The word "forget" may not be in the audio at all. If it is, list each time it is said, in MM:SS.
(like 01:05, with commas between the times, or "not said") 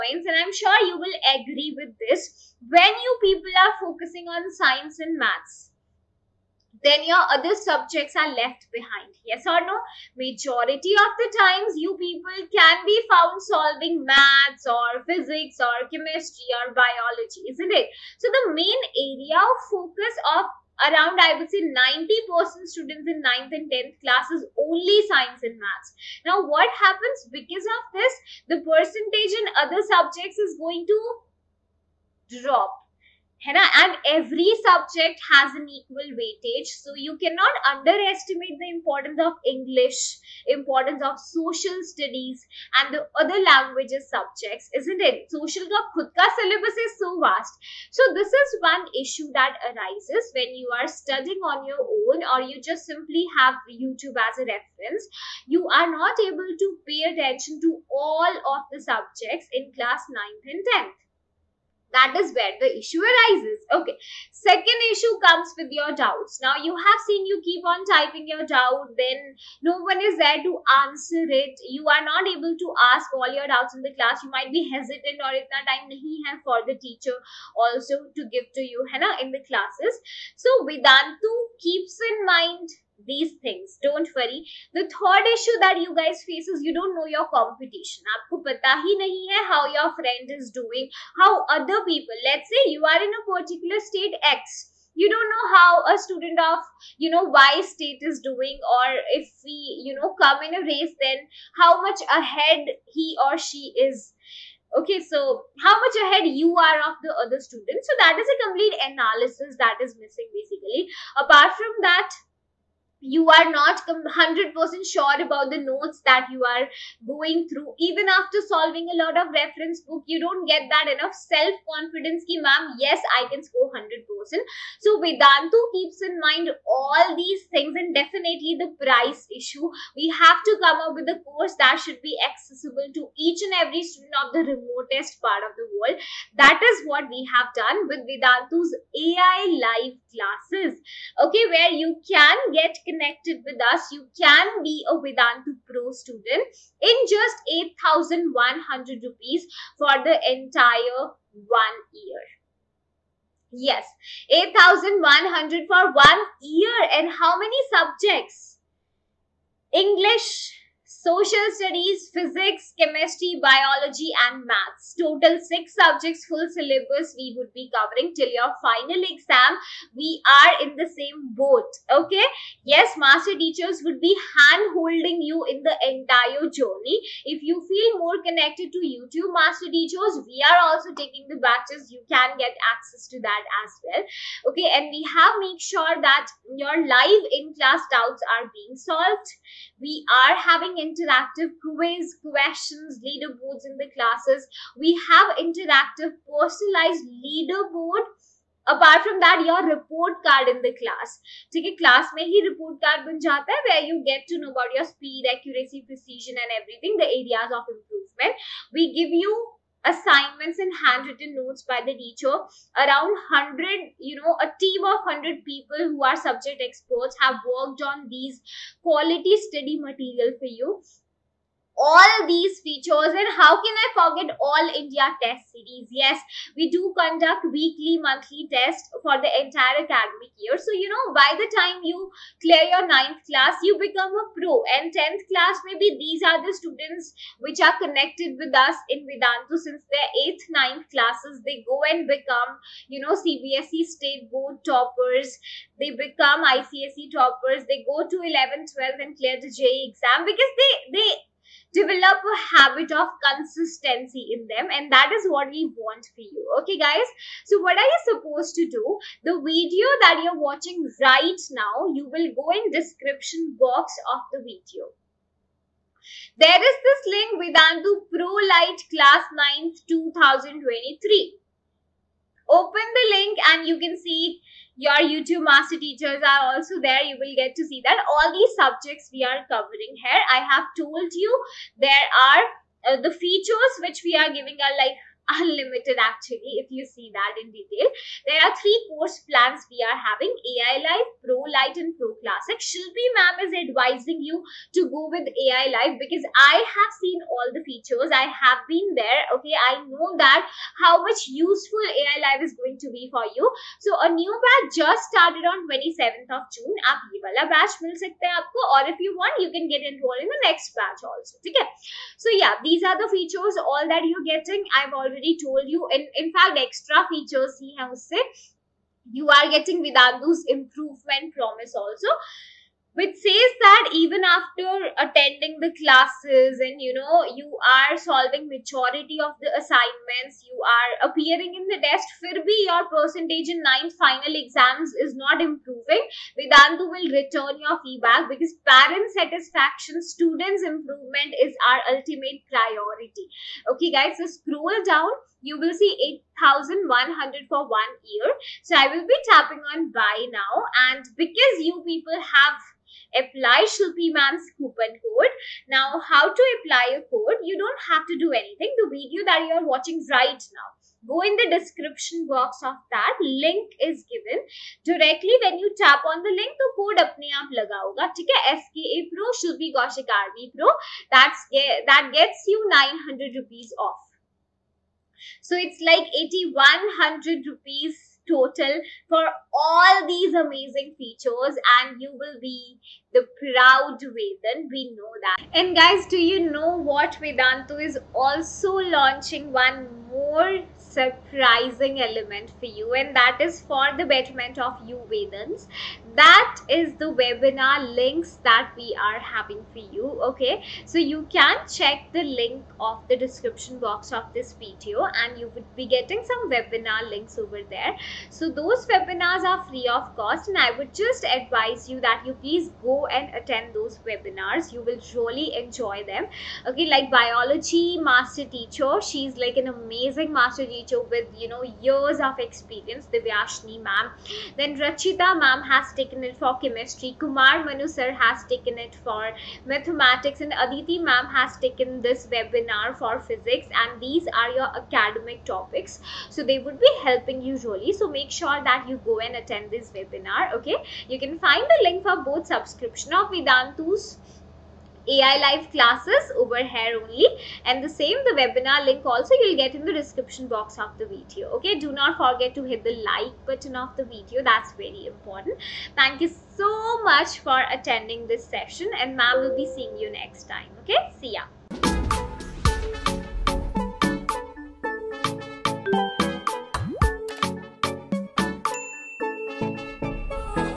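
03:43, 07:32.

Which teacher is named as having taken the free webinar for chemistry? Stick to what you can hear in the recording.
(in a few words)
Rachita ma'am.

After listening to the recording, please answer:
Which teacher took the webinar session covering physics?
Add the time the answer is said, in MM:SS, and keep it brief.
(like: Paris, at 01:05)
Aditi ma'am, at 07:10.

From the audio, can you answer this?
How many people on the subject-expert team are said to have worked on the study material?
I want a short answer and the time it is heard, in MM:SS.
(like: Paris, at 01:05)
100, at 03:34.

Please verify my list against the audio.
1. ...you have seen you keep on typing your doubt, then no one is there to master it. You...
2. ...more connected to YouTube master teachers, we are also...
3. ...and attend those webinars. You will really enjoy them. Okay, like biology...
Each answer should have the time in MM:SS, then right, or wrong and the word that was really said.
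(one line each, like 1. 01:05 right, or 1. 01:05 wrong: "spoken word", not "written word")
1. 01:06 wrong: "answer", not "master"
2. 02:57 right
3. 06:53 right.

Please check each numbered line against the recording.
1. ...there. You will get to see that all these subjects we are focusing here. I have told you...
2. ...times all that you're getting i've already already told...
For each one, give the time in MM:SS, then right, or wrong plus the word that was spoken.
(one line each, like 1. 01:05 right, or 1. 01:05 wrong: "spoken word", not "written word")
1. 04:36 wrong: "covering", not "focusing"
2. 05:13 wrong: "features", not "times".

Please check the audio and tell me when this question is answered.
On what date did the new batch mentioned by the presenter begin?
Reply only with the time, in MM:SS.
05:05.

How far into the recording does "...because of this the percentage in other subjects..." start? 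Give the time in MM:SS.
00:27.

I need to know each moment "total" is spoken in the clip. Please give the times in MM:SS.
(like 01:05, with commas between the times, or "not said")
02:44, 06:18.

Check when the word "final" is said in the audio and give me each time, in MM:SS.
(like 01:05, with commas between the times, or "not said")
02:48, 05:34.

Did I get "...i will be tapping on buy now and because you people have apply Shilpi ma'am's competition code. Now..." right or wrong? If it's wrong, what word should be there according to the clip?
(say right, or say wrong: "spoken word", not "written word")
wrong: "coupon", not "competition".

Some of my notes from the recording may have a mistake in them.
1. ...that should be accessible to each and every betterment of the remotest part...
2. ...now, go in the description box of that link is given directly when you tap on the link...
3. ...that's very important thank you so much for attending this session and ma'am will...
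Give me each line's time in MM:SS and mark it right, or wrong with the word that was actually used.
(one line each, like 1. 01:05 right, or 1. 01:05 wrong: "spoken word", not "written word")
1. 02:11 wrong: "student", not "betterment"
2. 06:00 right
3. 07:34 right.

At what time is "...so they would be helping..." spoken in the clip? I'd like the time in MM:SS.
07:16.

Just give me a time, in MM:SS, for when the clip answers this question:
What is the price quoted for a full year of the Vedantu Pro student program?
02:27.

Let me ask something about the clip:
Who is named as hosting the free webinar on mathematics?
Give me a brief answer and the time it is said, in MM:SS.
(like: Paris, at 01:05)
Kumar Manu sir, at 07:07.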